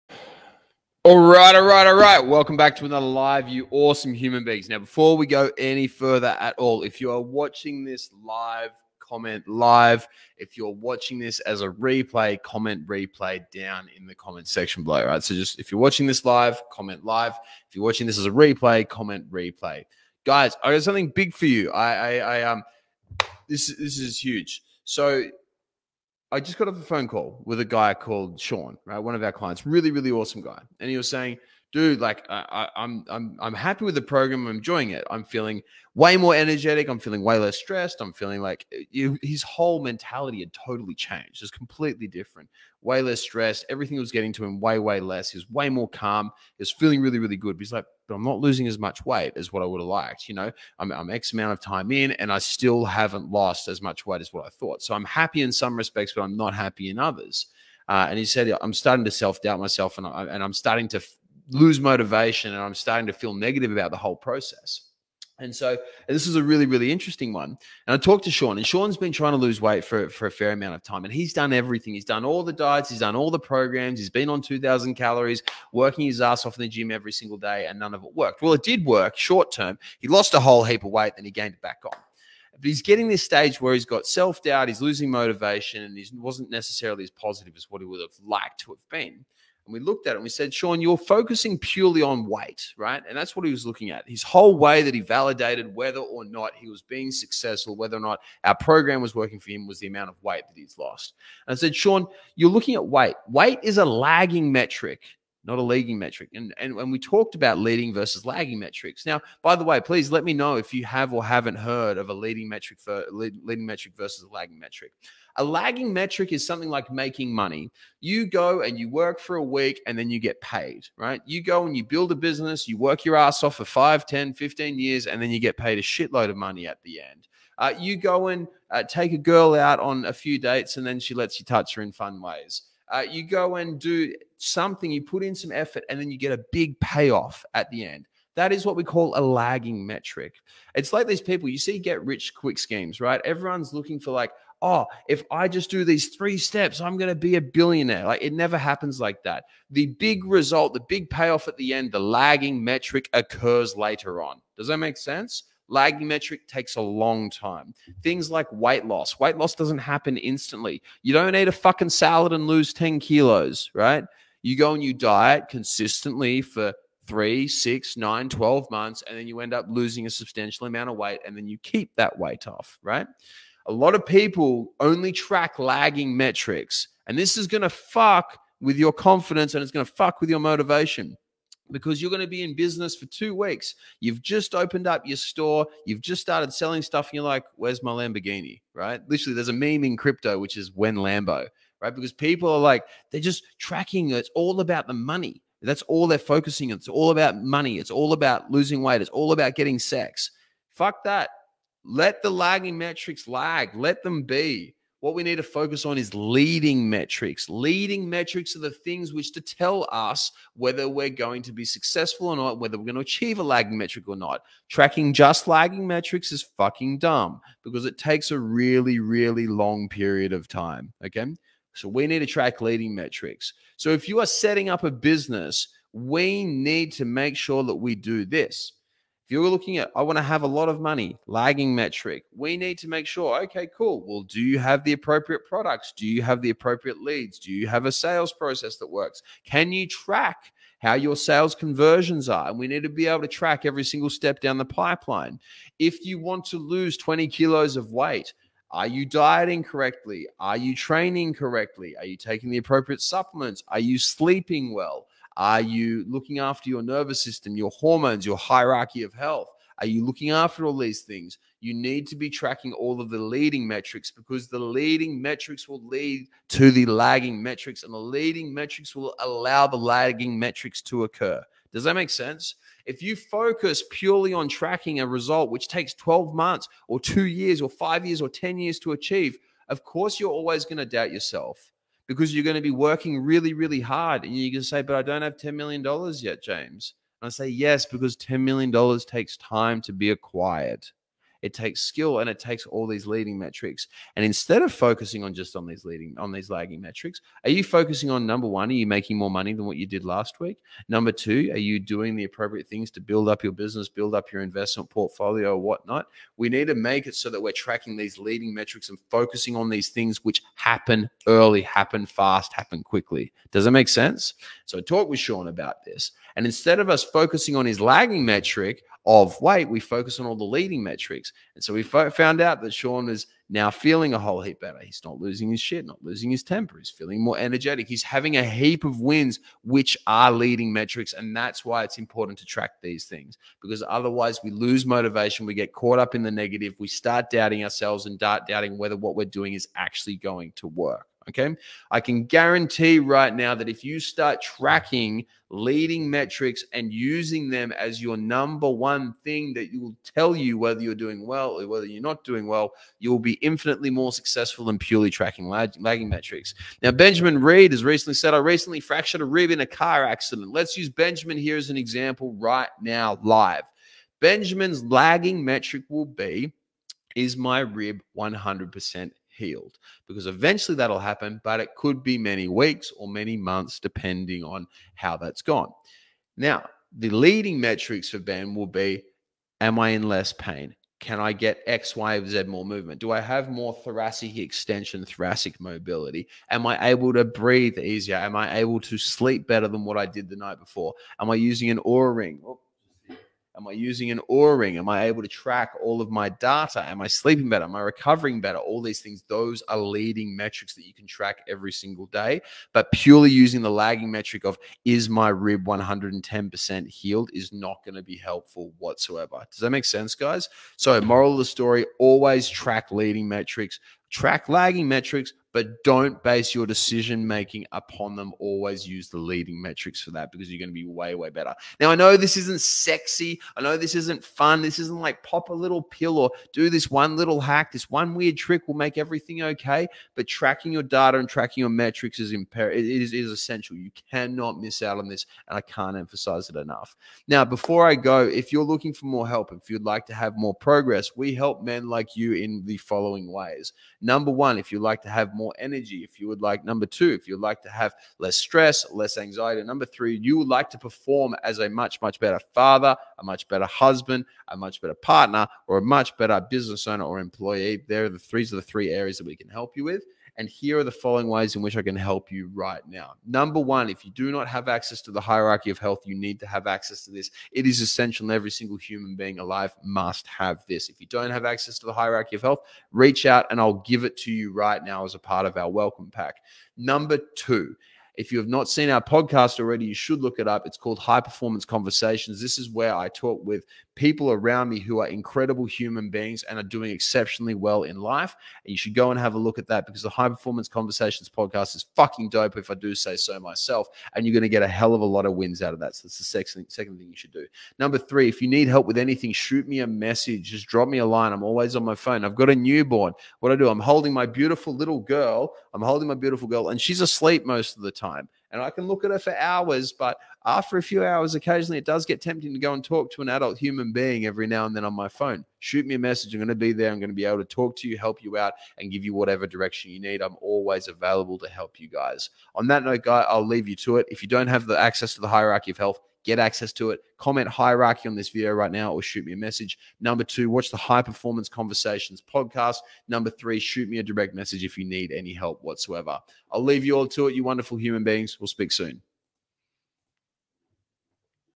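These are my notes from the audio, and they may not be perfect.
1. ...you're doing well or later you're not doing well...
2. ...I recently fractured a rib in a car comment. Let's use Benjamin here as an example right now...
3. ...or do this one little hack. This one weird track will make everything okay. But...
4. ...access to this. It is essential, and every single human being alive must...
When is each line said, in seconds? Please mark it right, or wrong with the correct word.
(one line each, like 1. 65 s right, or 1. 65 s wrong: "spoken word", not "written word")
1. 350 s wrong: "whether", not "later"
2. 358 s wrong: "accident", not "comment"
3. 426 s wrong: "trick", not "track"
4. 466 s right.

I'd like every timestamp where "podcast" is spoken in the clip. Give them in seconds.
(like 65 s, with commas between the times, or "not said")
479 s, 491 s, 532 s.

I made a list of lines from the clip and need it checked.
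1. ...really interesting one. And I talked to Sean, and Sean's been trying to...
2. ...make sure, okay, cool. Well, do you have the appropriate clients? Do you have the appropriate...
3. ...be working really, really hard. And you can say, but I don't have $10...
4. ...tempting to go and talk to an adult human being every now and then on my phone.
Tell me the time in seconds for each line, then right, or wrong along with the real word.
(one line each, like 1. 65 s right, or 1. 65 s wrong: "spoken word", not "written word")
1. 66 s right
2. 232 s wrong: "products", not "clients"
3. 282 s right
4. 512 s right.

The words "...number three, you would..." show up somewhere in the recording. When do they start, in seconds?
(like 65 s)
449 s.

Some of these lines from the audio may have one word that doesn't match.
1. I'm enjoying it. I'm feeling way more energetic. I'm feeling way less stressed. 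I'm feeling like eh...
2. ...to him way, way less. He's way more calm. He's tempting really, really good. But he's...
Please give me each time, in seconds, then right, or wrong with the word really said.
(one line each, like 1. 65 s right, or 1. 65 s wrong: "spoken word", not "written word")
1. 34 s right
2. 44 s wrong: "feeling", not "tempting".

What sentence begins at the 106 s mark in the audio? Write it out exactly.
And, and and we talked about leading versus lagging metrics.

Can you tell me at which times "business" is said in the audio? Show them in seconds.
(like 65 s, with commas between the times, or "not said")
122 s, 182 s, 224 s, 303 s, 456 s.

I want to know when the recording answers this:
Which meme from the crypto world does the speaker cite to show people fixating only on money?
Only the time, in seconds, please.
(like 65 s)
190 s.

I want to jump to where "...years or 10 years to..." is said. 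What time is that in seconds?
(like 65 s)
278 s.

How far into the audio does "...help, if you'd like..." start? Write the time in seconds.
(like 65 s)
439 s.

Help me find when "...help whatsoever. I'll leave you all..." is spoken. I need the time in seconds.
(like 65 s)
535 s.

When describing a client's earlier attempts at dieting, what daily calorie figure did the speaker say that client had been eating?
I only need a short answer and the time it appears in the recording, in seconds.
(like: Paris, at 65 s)
2,000, at 74 s.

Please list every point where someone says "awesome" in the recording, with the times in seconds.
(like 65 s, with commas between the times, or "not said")
3 s, 30 s.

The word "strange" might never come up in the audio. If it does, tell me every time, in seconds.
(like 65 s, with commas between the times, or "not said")
not said.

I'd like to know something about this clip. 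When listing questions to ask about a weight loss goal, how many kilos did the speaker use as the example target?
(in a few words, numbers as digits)
20.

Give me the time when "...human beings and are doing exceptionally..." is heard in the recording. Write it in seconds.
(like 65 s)
485 s.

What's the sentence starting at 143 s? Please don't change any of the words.
Everyone's looking for, like, oh, if I just do these three steps, I'm going to be a billionaire.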